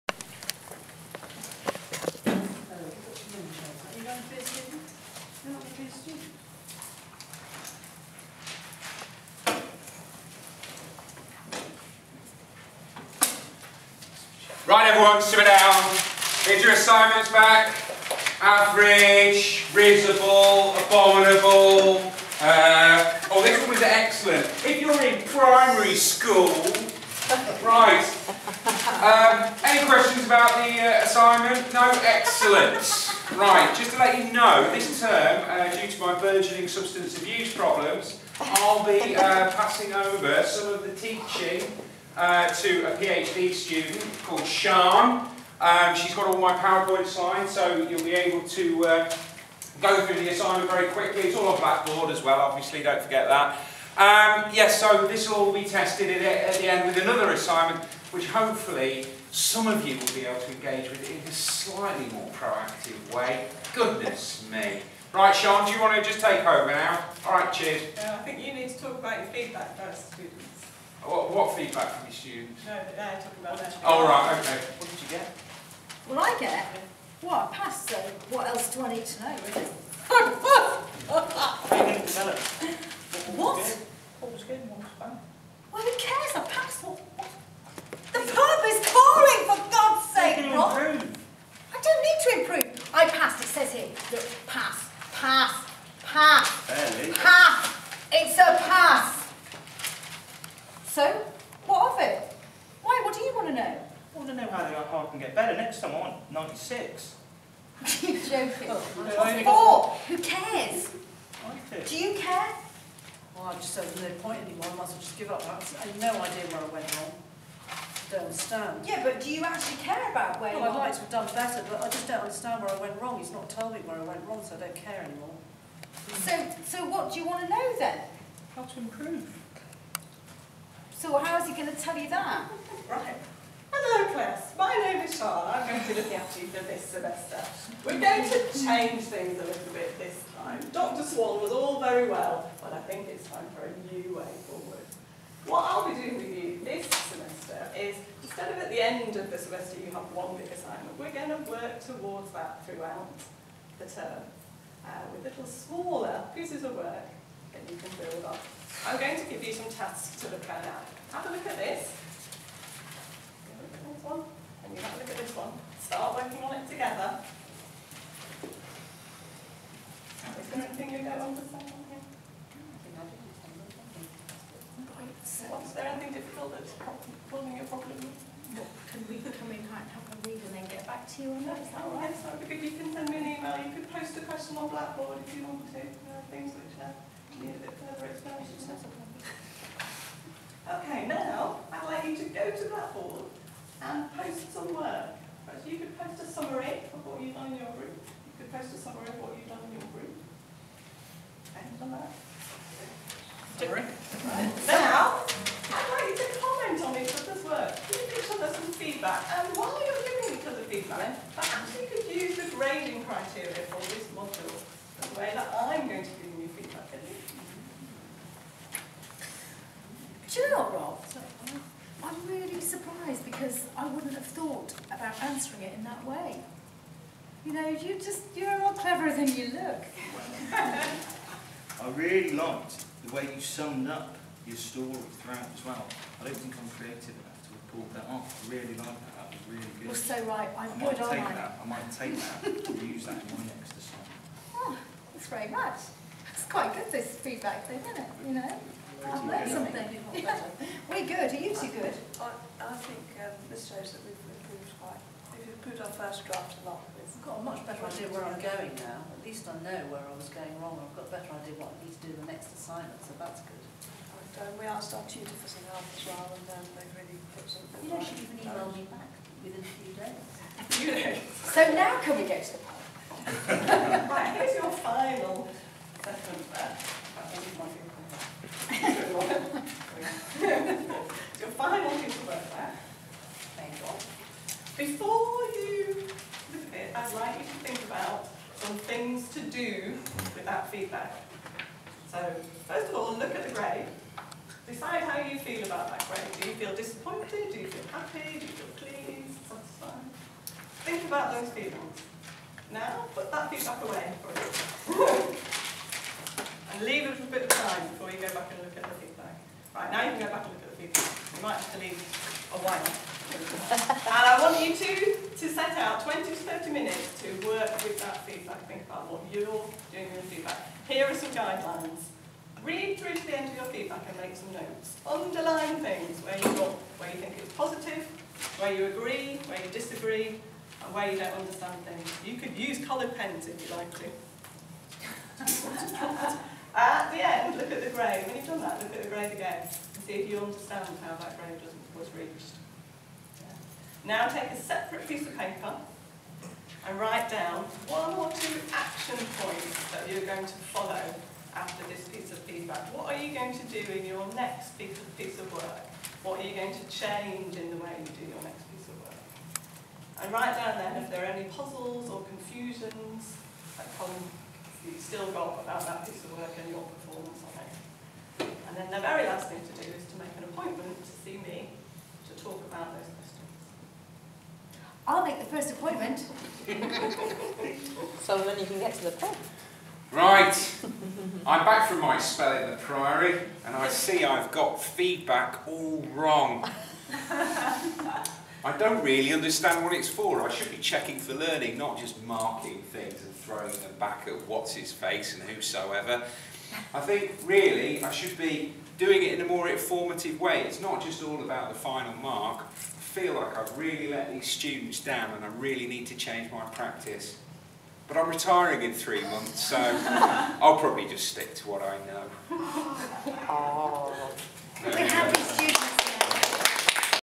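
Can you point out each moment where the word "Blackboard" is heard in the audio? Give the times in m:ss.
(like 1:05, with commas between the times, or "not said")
0:51, 3:04.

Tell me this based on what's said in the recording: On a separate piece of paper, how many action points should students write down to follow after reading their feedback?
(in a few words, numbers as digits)
1 or 2.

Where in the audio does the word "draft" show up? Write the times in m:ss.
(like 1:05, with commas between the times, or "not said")
4:16.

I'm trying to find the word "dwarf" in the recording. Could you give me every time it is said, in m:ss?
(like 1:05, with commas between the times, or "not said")
not said.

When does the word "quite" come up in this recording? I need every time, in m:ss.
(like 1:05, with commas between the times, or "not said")
4:06, 4:14.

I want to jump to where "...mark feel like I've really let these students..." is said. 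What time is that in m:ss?
6:42.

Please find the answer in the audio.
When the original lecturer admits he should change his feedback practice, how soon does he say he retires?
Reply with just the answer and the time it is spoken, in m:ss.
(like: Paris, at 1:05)
3 months, at 6:48.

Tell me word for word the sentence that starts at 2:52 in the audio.
Was there anything difficult that's causing you a problem?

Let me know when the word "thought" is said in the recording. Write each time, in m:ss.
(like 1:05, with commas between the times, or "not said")
3:44.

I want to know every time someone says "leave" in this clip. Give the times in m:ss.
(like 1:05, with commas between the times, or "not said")
5:06, 5:11.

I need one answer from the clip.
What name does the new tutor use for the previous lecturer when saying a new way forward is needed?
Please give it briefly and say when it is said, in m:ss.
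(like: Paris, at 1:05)
Dr. Swan, at 2:20.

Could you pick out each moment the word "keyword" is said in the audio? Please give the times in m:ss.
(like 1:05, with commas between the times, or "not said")
not said.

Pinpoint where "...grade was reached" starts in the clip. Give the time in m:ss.
5:41.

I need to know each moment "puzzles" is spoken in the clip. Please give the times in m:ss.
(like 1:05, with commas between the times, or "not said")
6:01.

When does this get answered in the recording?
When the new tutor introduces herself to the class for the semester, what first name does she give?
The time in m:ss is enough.
2:15.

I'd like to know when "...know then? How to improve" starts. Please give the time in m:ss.
2:07.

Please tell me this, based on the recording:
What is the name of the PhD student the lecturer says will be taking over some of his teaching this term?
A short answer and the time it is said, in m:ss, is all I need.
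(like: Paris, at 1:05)
Shan, at 0:44.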